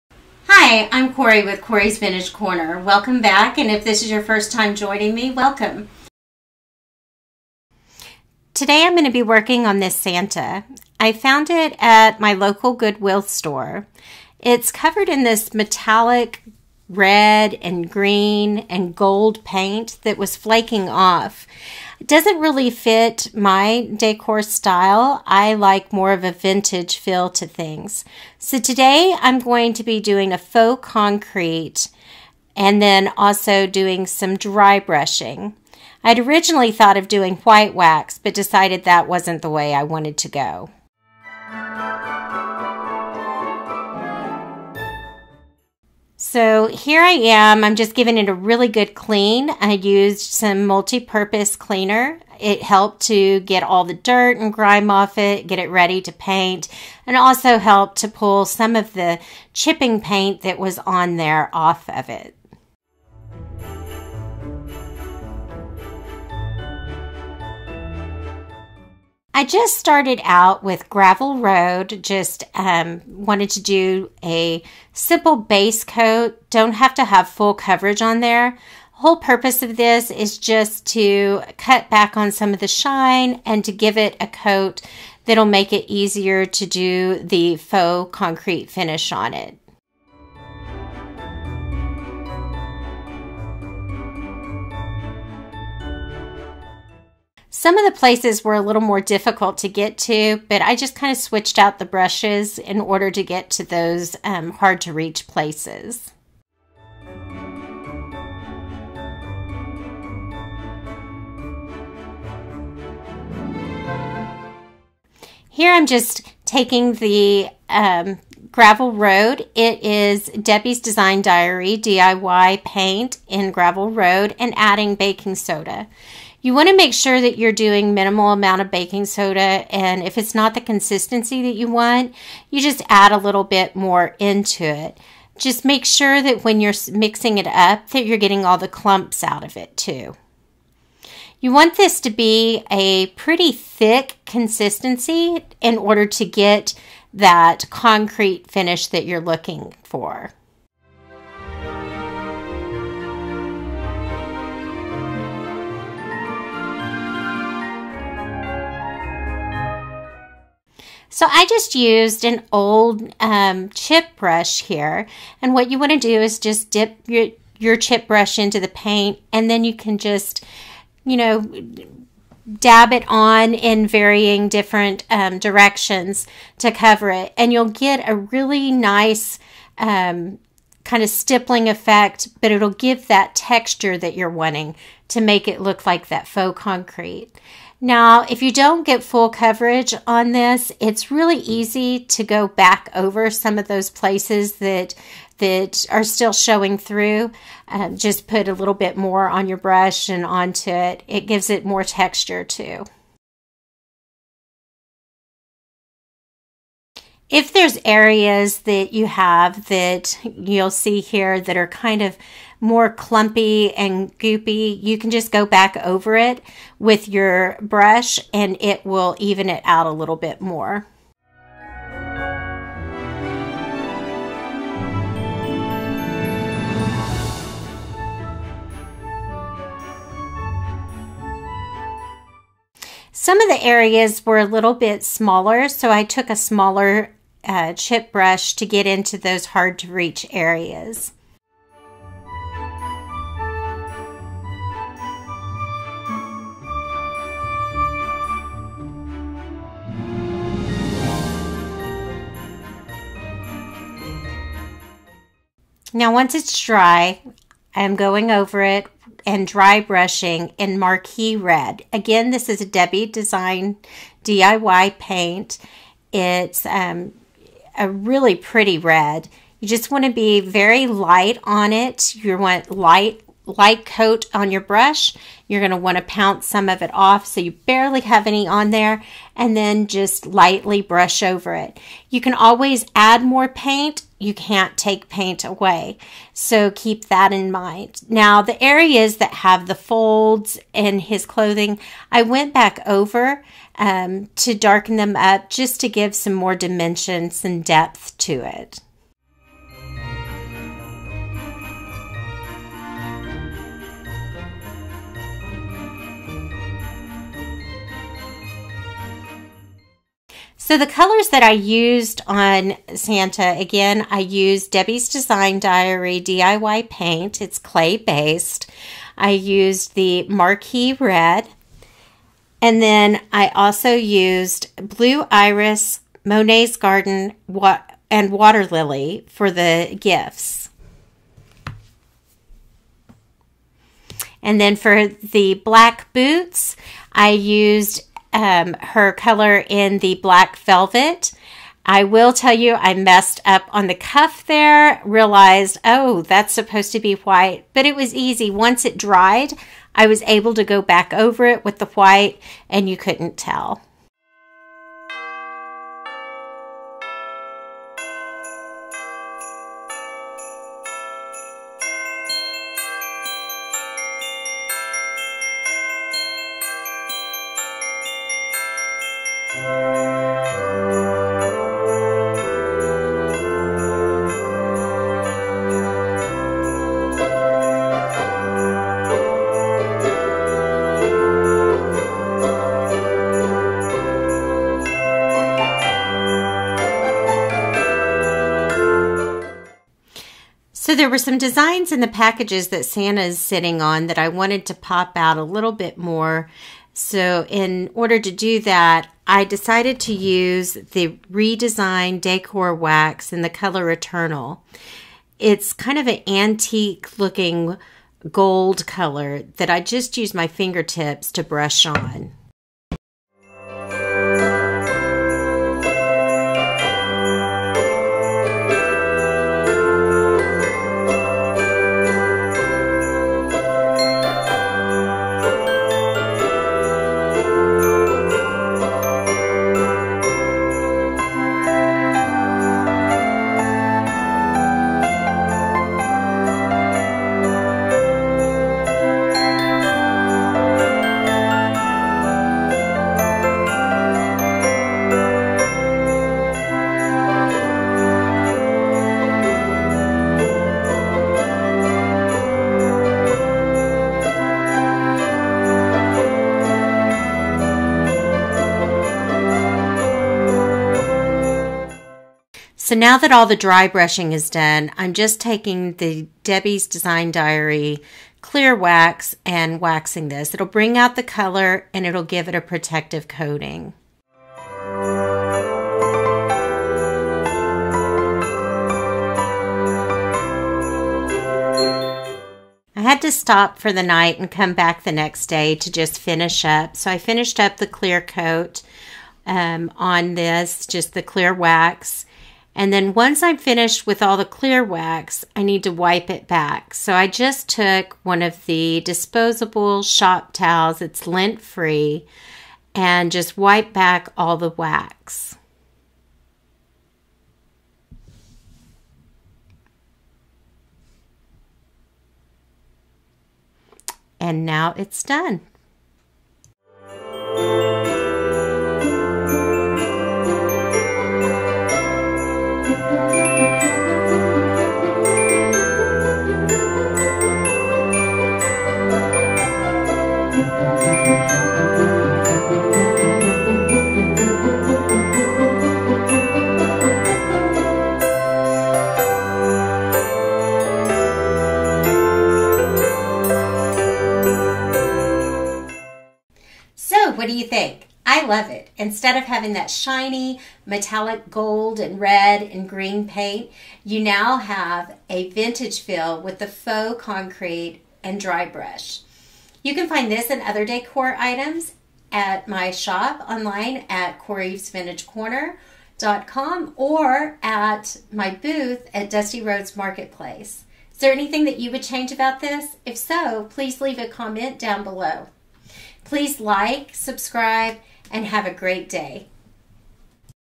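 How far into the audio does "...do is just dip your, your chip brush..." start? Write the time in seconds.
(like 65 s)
165 s.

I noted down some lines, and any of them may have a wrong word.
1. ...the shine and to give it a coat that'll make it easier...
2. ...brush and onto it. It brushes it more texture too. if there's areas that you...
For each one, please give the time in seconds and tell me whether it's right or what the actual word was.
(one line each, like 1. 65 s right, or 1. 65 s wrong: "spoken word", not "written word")
1. 82 s right
2. 199 s wrong: "gives", not "brushes".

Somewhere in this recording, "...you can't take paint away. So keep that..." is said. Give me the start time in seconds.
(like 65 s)
284 s.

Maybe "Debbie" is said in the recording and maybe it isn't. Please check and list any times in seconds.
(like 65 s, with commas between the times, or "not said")
120 s, 262 s, 314 s, 466 s.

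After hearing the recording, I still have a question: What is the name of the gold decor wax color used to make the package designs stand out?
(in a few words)
Eternal.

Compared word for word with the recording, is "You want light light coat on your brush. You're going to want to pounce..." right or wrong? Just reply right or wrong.
right.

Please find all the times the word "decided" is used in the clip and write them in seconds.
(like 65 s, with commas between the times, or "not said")
38 s, 399 s.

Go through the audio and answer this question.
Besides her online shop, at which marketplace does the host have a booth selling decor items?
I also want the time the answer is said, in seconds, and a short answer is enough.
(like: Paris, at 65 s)
Dusty Roads Marketplace, at 569 s.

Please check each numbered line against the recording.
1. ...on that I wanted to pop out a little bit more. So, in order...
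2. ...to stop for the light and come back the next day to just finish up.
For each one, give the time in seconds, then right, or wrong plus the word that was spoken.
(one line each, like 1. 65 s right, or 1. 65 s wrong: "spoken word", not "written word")
1. 393 s right
2. 483 s wrong: "night", not "light".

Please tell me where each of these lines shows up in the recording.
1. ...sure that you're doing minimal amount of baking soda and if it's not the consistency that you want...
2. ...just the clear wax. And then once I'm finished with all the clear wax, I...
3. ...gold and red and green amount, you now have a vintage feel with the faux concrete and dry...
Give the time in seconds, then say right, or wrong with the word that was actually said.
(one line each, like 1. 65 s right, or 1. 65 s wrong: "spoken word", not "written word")
1. 126 s right
2. 490 s right
3. 551 s wrong: "paint", not "amount".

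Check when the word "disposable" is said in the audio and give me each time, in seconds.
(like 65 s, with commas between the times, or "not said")
499 s.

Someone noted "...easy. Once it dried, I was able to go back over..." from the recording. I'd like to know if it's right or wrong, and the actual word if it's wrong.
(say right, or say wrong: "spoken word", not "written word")
right.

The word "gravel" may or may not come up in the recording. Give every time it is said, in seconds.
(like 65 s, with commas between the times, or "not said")
70 s, 118 s, 123 s.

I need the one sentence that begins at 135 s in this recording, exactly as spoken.
Just make sure that when you're mixing it up that you're getting all the clumps out of it too.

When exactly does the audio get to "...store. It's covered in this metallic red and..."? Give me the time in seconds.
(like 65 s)
13 s.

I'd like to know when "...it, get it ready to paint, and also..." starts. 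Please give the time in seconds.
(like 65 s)
55 s.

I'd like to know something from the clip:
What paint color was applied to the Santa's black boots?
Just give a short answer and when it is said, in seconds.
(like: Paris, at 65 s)
Black Velvet, at 340 s.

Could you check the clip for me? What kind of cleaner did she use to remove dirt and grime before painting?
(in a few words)
Multi-purpose cleaner.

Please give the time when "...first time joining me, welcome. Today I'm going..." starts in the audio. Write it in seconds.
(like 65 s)
4 s.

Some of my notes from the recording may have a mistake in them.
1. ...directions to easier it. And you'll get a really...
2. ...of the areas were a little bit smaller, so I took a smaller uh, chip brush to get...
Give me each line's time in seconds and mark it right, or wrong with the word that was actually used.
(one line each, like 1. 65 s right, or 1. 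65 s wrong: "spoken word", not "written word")
1. 175 s wrong: "cover", not "easier"
2. 233 s right.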